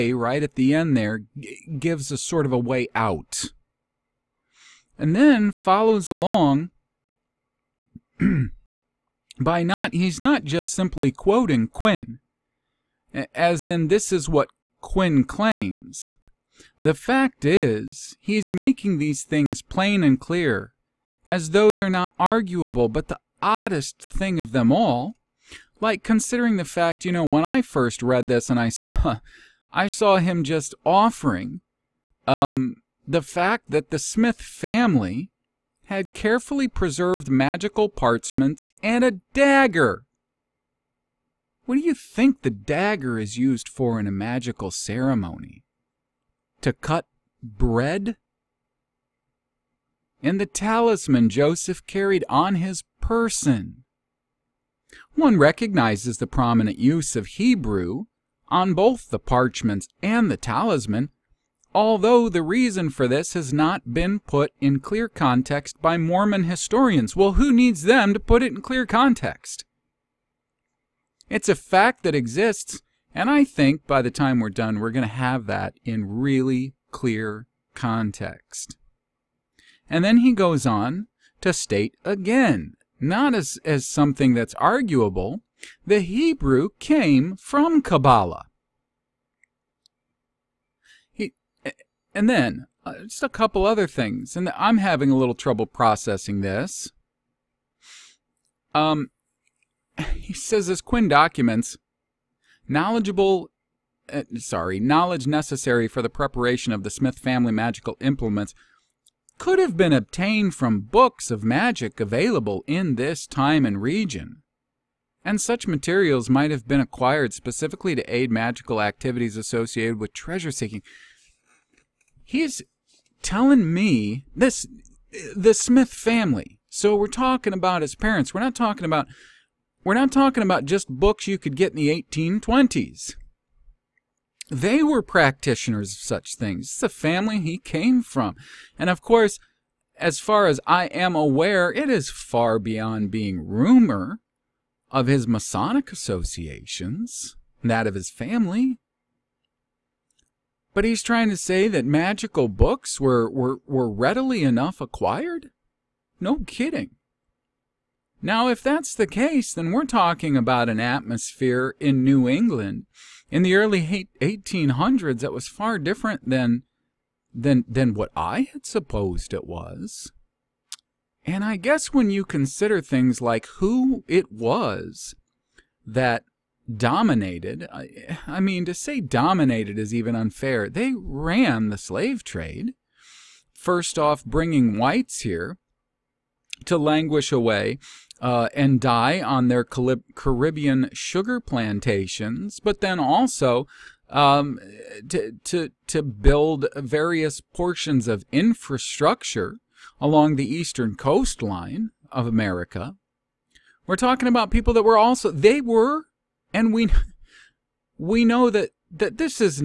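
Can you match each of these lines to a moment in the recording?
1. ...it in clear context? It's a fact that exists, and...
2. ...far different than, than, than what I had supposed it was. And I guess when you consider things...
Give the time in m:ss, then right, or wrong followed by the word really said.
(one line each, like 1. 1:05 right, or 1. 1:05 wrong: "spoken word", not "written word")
1. 1:08 right
2. 2:45 right.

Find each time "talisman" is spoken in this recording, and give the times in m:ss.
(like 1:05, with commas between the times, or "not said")
0:50, 1:00.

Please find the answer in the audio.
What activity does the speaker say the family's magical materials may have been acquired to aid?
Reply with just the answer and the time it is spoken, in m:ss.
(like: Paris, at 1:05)
Treasure seeking, at 2:00.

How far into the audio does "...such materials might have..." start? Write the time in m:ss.
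1:55.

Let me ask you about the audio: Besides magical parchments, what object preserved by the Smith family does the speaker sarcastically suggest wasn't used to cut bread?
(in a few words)
A dagger.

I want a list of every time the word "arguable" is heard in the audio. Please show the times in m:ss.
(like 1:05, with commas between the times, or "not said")
0:22, 1:24.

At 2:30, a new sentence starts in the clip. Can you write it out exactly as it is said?
But he's trying to say that magical books were, were, were readily enough acquired?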